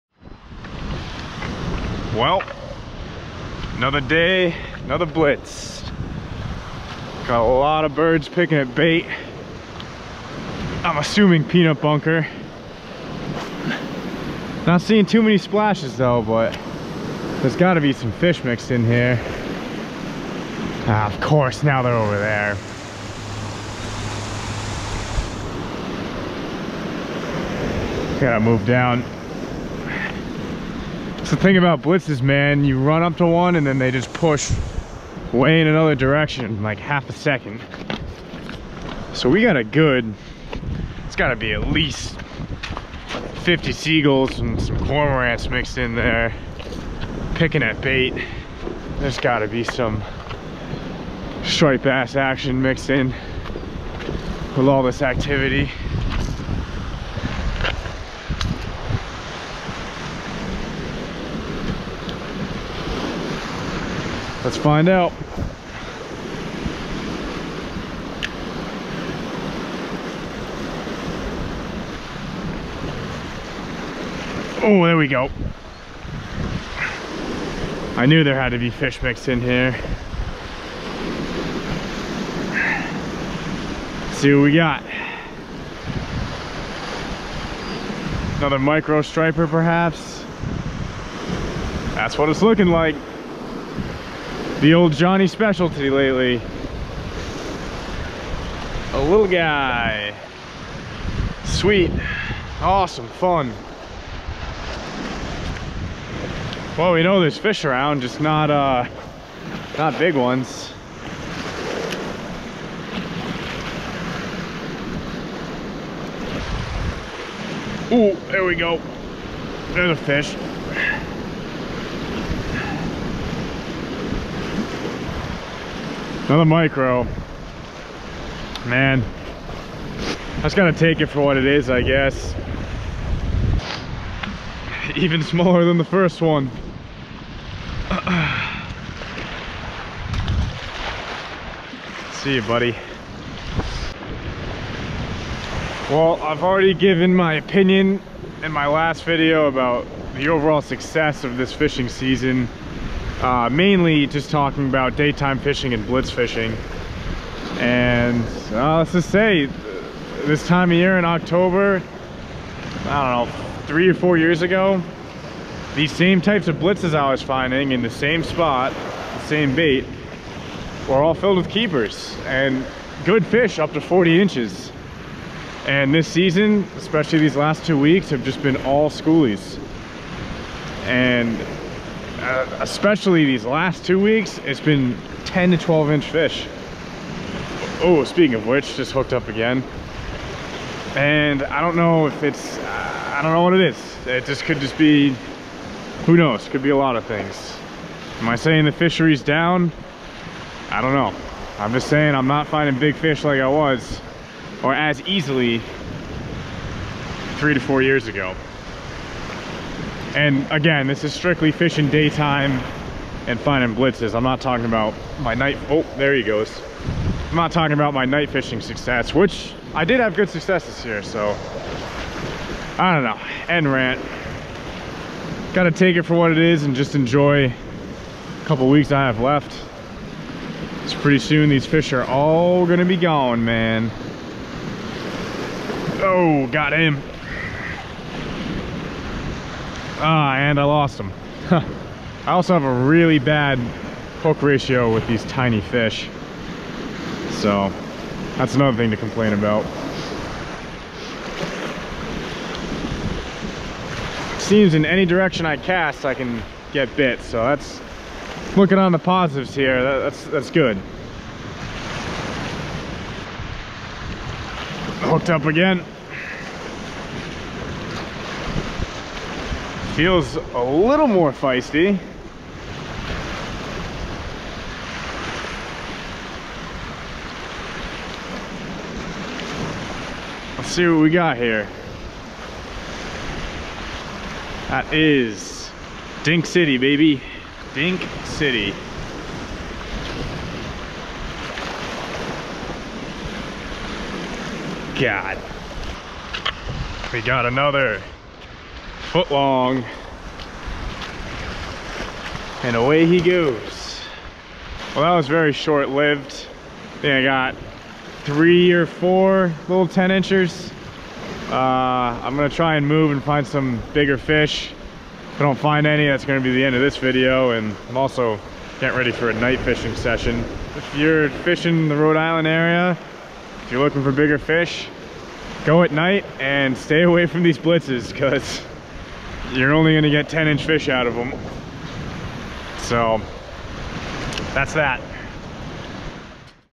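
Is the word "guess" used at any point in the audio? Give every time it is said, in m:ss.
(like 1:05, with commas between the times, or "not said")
2:11.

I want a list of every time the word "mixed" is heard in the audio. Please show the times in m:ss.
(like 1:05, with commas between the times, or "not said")
0:18, 0:45, 0:52, 1:19.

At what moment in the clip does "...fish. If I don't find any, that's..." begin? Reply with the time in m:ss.
5:14.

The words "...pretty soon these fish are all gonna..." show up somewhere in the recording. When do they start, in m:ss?
3:50.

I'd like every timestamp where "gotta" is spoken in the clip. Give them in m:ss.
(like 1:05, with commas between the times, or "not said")
0:17, 0:28, 0:41, 0:49, 3:45.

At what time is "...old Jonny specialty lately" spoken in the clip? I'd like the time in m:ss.
1:34.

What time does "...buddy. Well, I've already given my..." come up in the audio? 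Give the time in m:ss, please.
2:22.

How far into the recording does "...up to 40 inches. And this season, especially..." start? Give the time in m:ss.
2:53.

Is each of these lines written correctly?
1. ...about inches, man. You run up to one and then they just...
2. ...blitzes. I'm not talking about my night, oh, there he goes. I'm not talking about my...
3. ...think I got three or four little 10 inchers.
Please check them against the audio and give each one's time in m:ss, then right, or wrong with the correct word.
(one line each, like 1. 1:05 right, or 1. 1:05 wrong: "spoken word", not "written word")
1. 0:31 wrong: "blitzes", not "inches"
2. 3:33 right
3. 5:06 right.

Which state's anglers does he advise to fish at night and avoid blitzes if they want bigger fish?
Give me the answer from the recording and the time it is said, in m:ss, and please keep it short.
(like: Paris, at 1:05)
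Rhode Island, at 5:21.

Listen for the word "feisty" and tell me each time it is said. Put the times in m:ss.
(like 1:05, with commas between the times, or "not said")
4:31.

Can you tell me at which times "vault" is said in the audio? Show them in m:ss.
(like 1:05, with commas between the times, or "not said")
not said.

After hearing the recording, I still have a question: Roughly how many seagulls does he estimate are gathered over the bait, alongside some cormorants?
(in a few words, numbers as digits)
50.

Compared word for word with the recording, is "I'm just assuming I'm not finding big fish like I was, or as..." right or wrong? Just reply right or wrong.
wrong.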